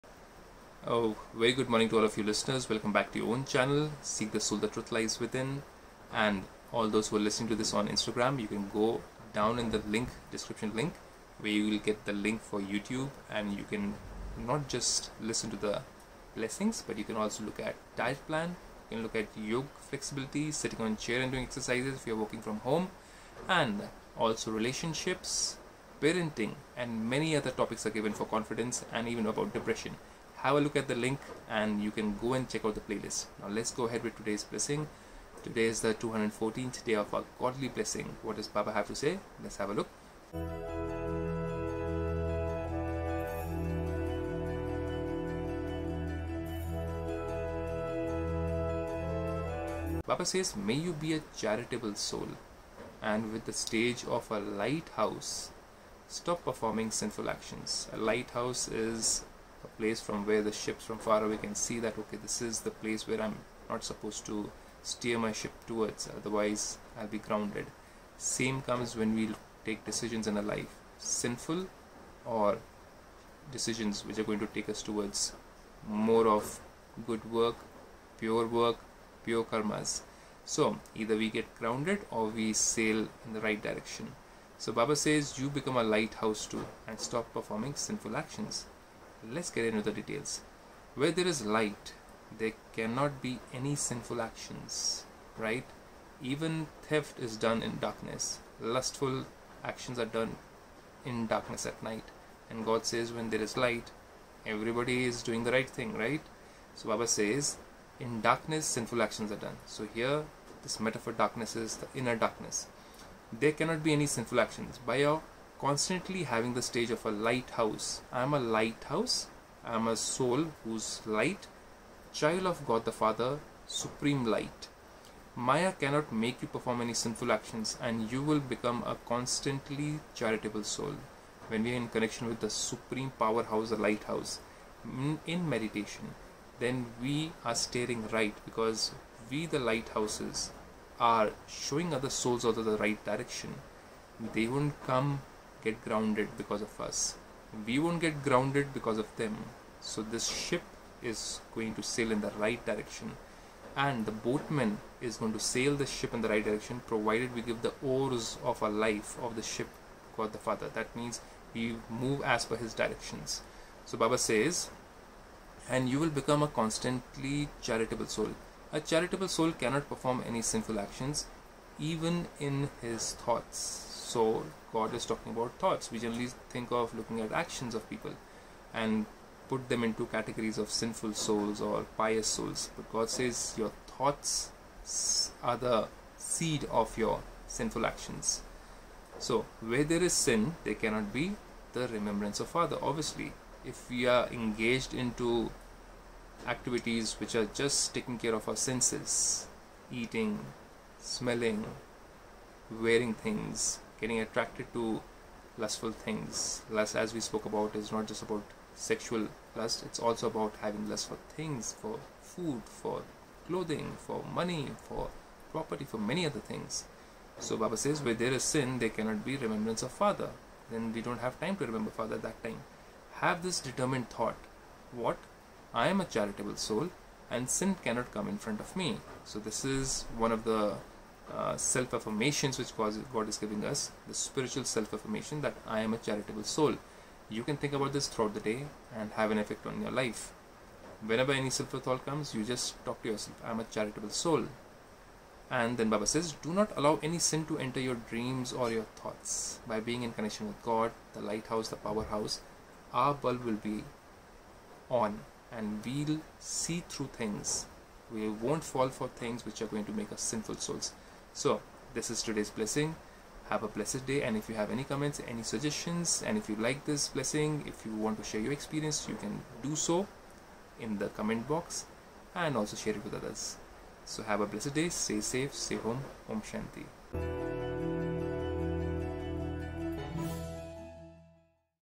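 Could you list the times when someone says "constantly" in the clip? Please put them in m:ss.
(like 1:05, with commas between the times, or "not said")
1:55, 2:09, 2:46.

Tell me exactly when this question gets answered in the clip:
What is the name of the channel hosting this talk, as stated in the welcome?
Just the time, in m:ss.
0:04.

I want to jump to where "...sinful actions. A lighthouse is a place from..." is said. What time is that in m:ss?
0:56.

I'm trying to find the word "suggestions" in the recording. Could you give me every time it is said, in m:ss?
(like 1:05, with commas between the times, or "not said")
4:25.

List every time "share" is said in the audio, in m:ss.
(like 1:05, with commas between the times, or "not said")
4:28, 4:32.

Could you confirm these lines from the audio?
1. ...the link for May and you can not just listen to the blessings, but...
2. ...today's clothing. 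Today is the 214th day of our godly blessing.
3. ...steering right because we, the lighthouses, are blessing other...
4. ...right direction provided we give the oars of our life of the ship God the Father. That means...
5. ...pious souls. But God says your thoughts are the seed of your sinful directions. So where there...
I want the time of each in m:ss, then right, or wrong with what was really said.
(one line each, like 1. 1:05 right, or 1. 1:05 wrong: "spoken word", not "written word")
1. 0:12 wrong: "YouTube", not "May"
2. 0:34 wrong: "blessing", not "clothing"
3. 2:17 wrong: "showing", not "blessing"
4. 2:36 right
5. 3:01 wrong: "actions", not "directions".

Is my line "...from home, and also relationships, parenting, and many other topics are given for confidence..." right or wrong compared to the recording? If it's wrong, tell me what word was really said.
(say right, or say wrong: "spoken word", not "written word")
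right.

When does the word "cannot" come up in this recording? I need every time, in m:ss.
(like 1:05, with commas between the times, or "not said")
1:32, 1:53, 2:05, 2:49, 3:10, 3:38, 3:47.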